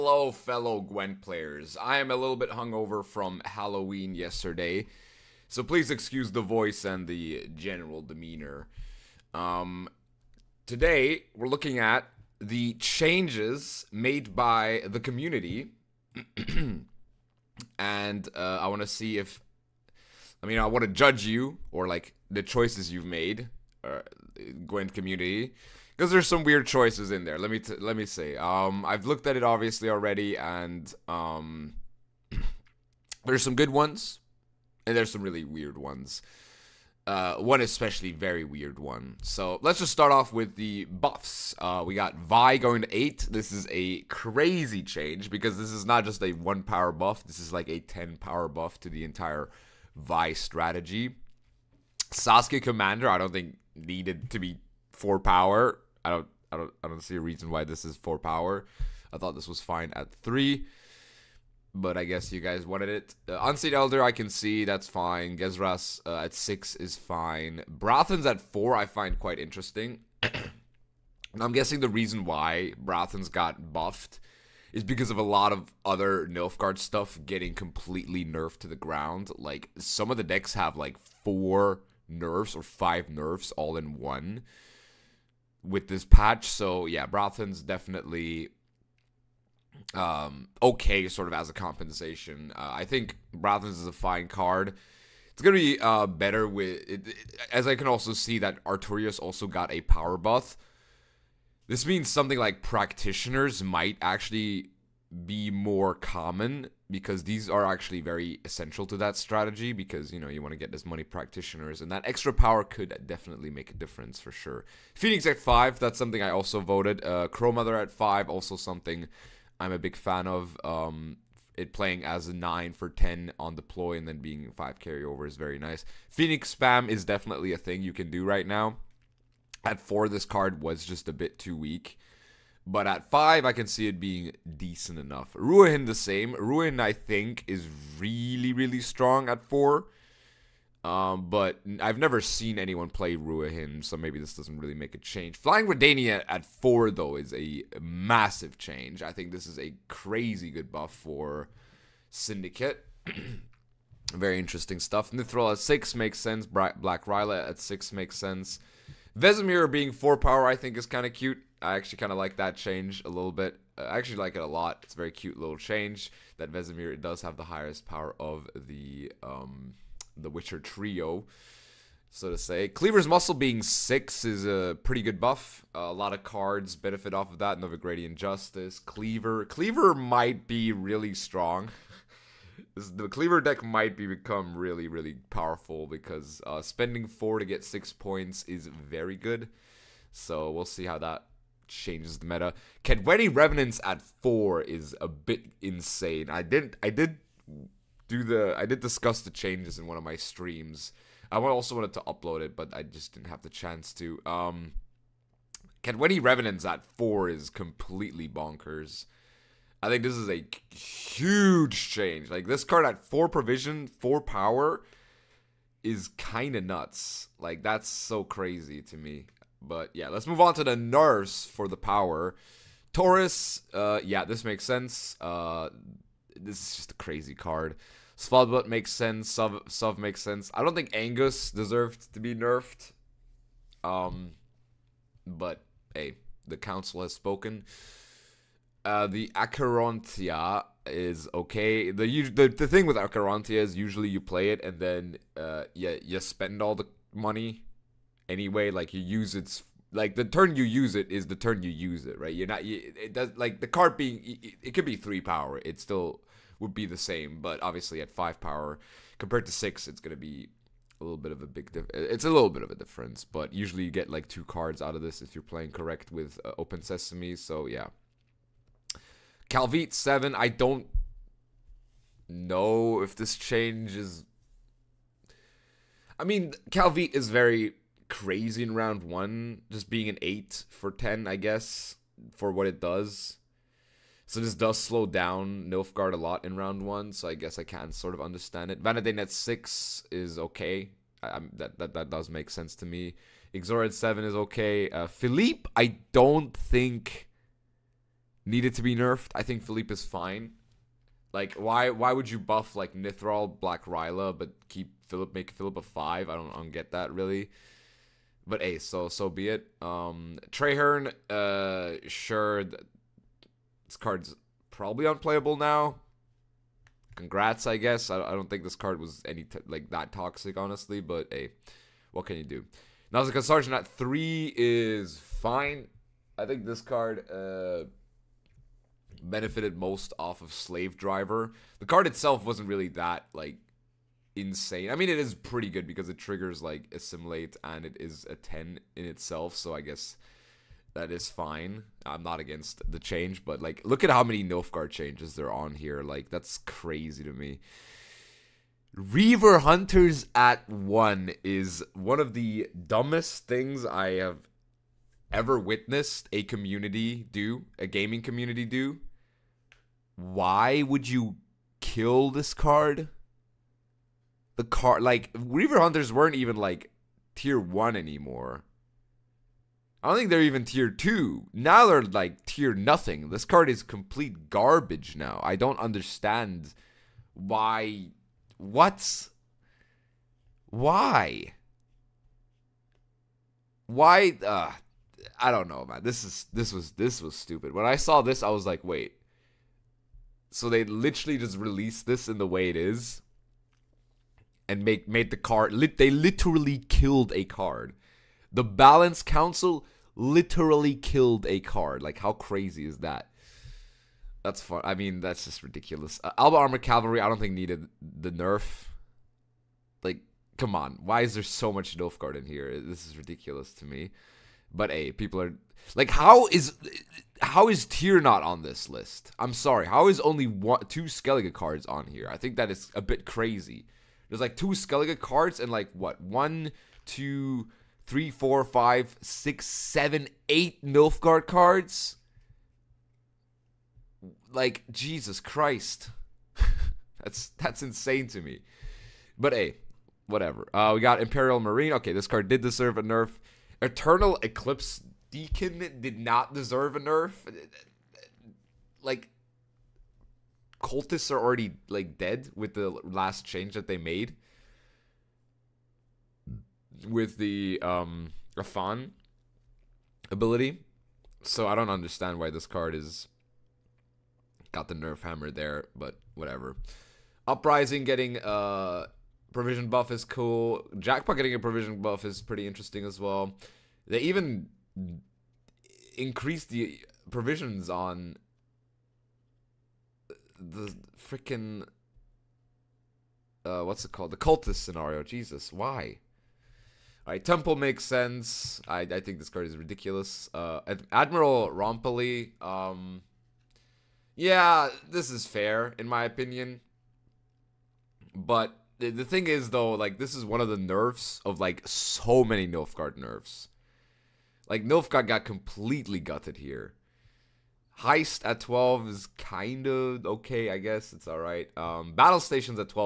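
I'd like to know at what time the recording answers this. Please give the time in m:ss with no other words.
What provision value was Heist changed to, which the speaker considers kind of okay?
8:28.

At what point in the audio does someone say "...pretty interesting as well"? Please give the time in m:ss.
7:52.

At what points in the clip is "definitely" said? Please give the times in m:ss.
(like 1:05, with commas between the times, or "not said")
1:27, 1:53, 2:07.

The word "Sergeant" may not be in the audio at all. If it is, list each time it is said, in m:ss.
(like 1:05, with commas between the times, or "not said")
5:23.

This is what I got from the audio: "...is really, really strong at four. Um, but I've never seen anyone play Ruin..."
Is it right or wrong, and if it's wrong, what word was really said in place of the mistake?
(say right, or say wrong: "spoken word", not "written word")
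right.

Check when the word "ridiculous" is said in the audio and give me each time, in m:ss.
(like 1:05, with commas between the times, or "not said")
6:45, 6:53, 8:09.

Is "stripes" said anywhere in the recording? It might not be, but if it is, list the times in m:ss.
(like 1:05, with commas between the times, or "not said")
not said.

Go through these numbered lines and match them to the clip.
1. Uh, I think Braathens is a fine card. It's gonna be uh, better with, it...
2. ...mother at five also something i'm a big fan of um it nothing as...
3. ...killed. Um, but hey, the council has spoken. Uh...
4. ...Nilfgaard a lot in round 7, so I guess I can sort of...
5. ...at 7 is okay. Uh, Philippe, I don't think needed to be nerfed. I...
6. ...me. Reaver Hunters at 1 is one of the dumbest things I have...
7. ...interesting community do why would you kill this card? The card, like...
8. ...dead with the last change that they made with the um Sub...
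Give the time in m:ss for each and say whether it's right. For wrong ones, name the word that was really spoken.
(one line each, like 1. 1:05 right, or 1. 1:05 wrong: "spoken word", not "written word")
1. 1:32 right
2. 1:57 wrong: "playing", not "nothing"
3. 3:52 wrong: "nerfed", not "killed"
4. 4:45 wrong: "1", not "7"
5. 4:53 right
6. 5:47 right
7. 5:57 wrong: "gaming", not "interesting"
8. 7:32 wrong: "Rafan", not "Sub".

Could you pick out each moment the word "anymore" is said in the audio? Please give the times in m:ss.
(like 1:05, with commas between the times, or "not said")
6:07.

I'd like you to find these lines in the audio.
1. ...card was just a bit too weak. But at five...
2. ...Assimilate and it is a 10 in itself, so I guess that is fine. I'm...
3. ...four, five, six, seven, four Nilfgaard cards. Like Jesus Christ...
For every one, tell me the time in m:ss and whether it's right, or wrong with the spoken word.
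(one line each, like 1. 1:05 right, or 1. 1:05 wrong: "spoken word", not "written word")
1. 2:10 right
2. 5:36 right
3. 7:08 wrong: "eight", not "four".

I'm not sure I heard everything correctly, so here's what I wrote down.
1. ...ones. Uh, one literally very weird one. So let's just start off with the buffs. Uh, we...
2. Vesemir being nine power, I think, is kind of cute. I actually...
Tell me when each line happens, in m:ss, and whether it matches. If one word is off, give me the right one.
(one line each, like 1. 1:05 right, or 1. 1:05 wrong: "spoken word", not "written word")
1. 0:35 wrong: "especially", not "literally"
2. 2:39 wrong: "four", not "nine".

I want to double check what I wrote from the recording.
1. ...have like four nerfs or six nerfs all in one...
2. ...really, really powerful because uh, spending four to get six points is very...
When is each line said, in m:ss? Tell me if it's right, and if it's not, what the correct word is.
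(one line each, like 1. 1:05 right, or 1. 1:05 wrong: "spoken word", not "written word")
1. 1:20 wrong: "five", not "six"
2. 3:04 right.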